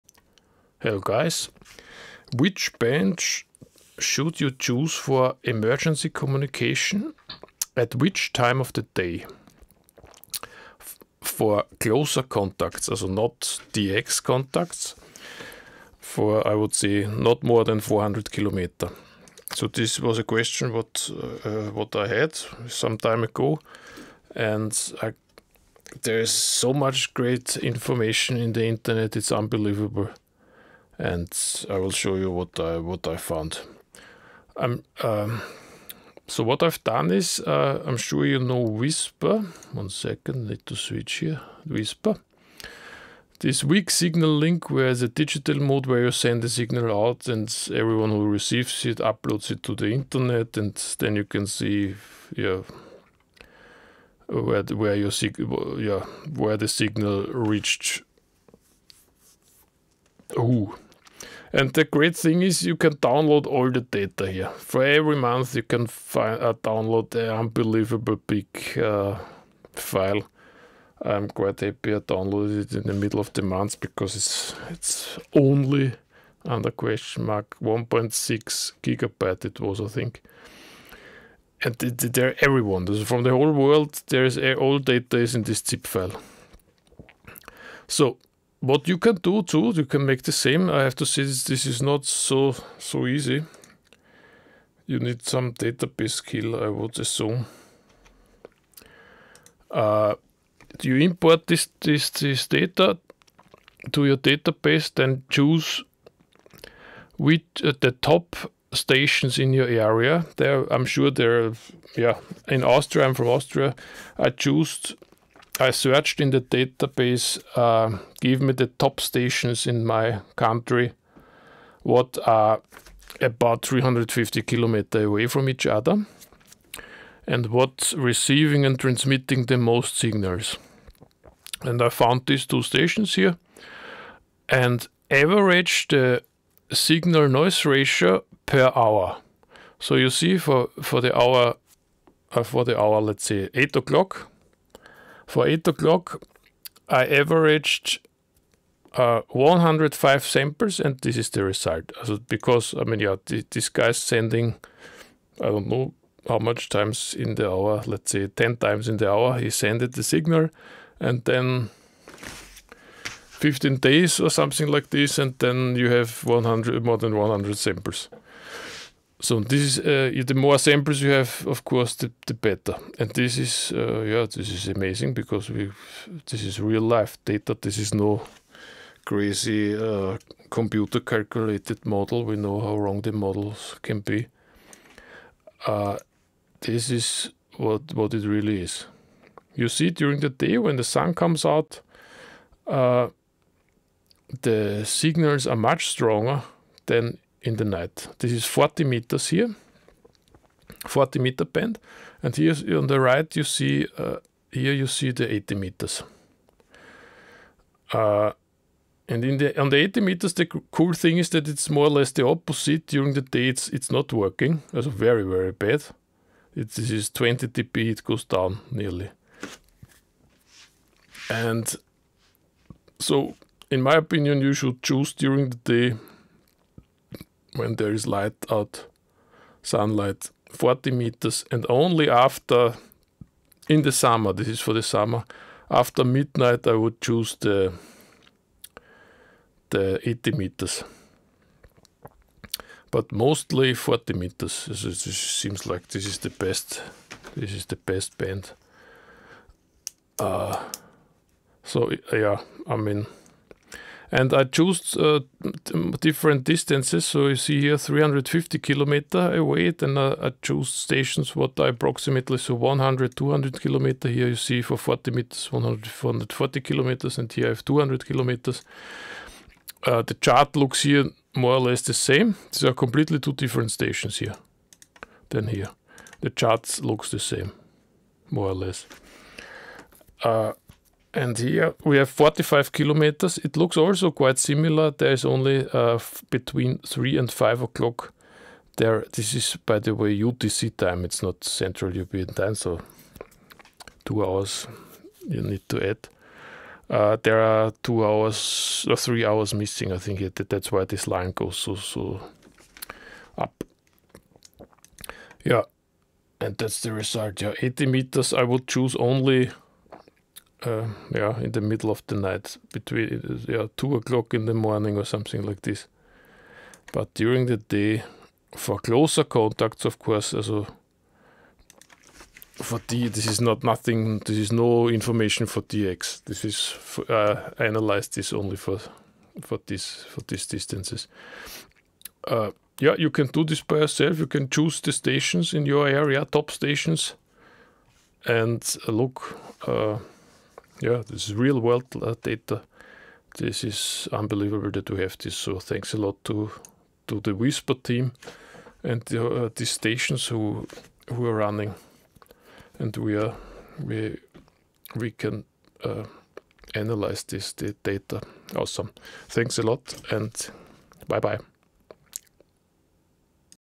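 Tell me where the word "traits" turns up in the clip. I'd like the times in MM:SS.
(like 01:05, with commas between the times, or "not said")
not said.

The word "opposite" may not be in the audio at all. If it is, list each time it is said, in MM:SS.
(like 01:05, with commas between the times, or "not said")
03:32.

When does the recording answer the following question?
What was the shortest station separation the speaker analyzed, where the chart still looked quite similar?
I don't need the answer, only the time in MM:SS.
04:42.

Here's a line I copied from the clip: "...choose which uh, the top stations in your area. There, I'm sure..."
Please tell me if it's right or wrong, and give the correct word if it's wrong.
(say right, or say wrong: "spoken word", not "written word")
right.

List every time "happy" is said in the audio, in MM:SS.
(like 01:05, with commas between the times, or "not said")
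01:11.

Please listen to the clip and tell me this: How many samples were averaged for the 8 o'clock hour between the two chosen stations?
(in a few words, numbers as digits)
105.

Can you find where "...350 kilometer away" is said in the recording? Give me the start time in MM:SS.
04:17.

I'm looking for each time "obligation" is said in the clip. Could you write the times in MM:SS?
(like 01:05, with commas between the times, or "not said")
not said.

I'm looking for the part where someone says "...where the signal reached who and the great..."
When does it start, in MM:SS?
00:56.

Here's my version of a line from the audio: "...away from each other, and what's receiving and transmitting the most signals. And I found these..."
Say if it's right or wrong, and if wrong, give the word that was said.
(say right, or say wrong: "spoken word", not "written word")
right.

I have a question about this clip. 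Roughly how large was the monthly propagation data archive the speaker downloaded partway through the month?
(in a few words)
1.6 gigabyte.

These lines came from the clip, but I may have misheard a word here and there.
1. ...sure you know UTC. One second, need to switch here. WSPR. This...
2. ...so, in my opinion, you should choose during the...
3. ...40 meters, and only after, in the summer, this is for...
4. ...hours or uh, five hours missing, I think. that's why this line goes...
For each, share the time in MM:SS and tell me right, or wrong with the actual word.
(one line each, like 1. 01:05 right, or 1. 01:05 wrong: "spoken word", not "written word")
1. 00:37 wrong: "WSPR", not "UTC"
2. 03:42 right
3. 03:50 right
4. 04:58 wrong: "three", not "five".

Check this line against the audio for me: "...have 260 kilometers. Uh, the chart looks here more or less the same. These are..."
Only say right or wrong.
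wrong.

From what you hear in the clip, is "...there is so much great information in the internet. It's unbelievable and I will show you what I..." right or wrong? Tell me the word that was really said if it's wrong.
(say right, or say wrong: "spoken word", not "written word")
right.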